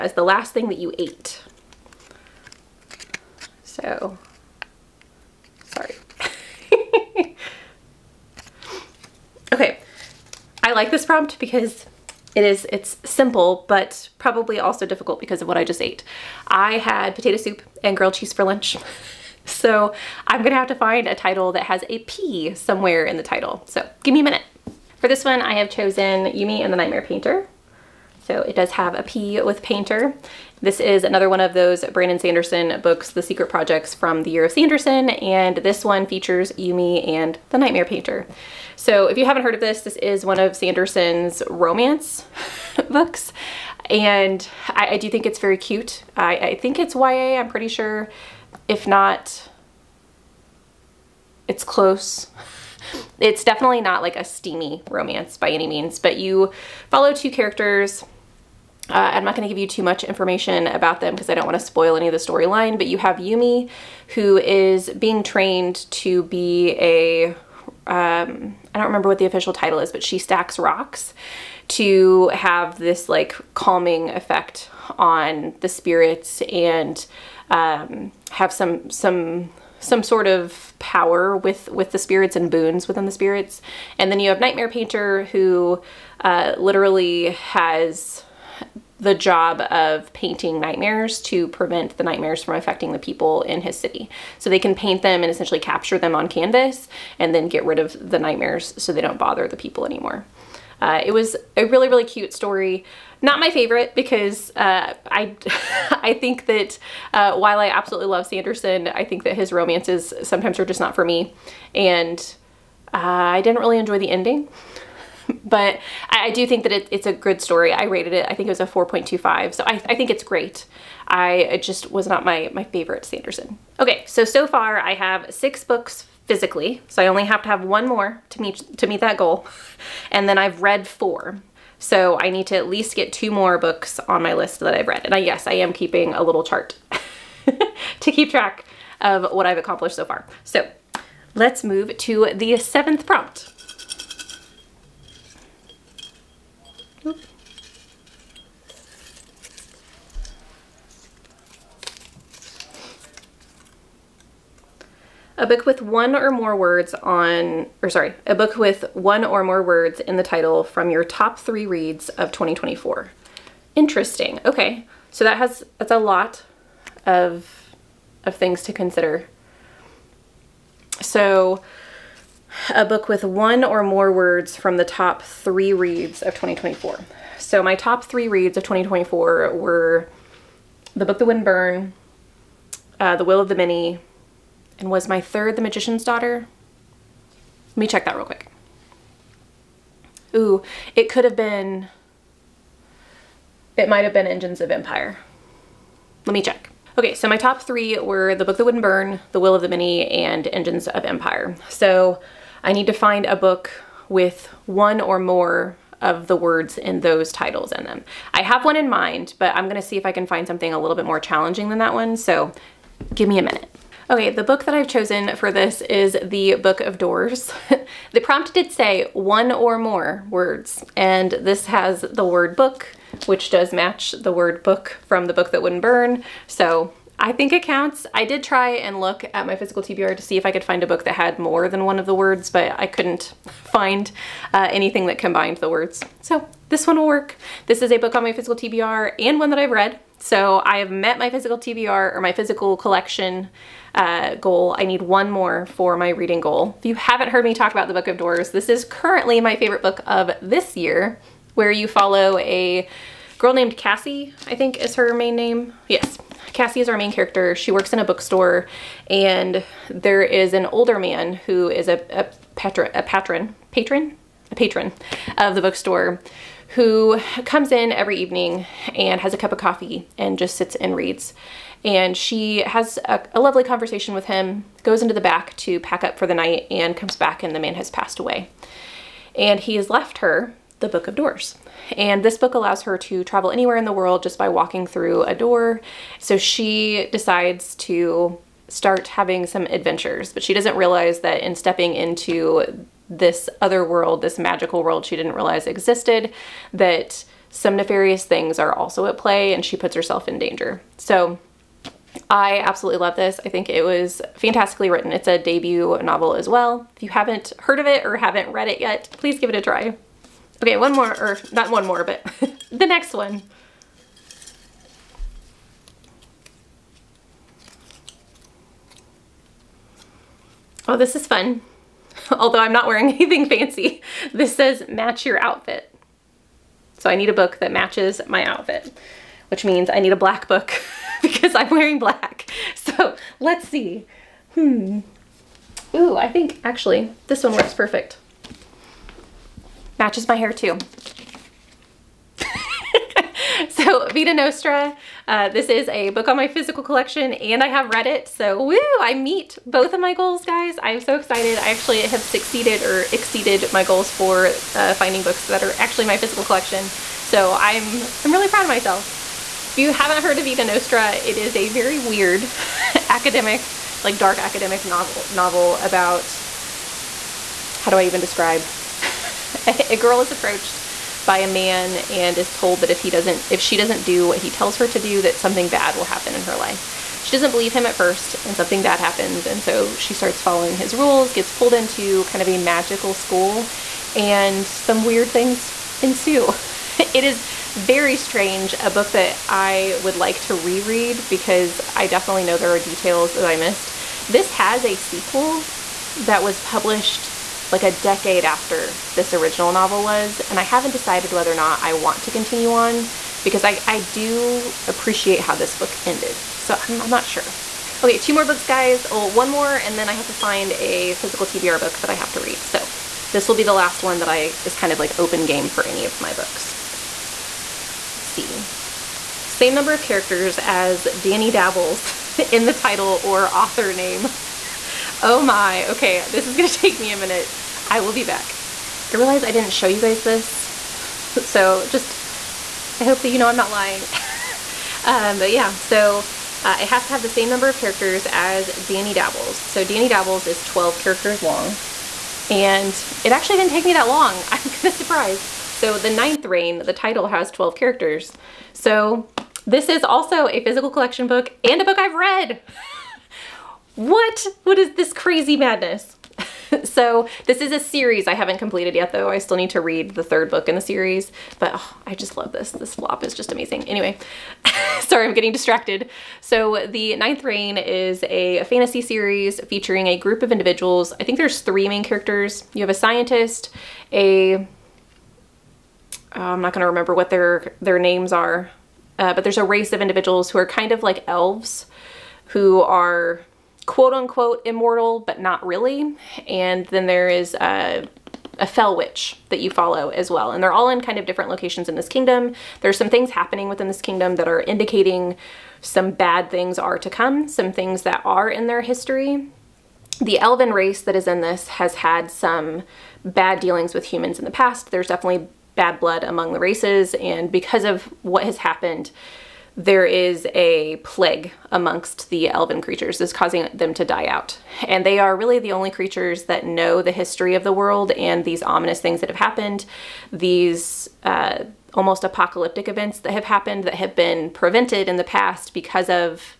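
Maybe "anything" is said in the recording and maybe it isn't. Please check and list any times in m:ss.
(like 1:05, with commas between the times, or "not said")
3:54, 5:23.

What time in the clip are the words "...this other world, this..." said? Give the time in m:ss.
4:53.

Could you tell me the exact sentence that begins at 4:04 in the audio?
I need one more for my reading goal.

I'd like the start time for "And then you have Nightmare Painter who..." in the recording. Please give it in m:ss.
1:23.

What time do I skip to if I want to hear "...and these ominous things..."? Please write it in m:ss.
8:38.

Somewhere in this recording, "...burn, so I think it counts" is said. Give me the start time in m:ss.
3:45.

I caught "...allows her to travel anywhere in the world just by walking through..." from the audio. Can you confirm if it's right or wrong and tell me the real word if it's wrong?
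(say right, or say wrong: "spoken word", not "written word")
right.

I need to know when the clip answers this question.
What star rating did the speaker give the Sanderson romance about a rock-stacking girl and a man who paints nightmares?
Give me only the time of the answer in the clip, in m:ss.
1:58.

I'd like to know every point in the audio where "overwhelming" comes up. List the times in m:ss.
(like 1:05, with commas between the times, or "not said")
not said.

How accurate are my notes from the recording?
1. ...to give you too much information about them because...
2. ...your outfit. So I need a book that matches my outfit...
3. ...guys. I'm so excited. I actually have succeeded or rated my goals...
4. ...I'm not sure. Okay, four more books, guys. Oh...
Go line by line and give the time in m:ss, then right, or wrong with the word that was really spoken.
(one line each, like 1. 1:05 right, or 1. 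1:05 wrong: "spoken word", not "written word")
1. 0:59 right
2. 5:25 right
3. 5:50 wrong: "exceeded", not "rated"
4. 6:47 wrong: "two", not "four".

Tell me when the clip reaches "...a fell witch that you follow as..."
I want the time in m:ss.
8:08.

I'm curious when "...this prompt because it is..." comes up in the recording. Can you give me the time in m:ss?
0:10.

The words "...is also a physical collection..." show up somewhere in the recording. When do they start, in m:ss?
7:29.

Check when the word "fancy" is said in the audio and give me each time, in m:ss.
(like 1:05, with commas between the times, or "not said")
5:23.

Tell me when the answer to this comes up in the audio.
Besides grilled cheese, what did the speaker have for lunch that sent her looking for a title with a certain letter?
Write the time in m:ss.
0:17.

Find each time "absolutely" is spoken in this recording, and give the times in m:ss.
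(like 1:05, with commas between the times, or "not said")
1:47, 5:02.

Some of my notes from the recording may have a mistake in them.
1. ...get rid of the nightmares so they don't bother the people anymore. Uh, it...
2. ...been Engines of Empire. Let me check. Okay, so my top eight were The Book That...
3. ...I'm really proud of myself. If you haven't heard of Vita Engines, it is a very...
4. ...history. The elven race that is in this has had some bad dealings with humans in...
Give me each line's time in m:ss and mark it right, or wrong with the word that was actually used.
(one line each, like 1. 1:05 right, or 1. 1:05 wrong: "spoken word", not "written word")
1. 1:37 right
2. 3:14 wrong: "three", not "eight"
3. 5:58 wrong: "Nostra", not "Engines"
4. 8:18 right.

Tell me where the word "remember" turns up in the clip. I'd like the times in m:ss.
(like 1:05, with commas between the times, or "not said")
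1:08, 7:56.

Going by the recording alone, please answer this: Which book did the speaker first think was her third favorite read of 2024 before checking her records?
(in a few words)
The Magician's Daughter.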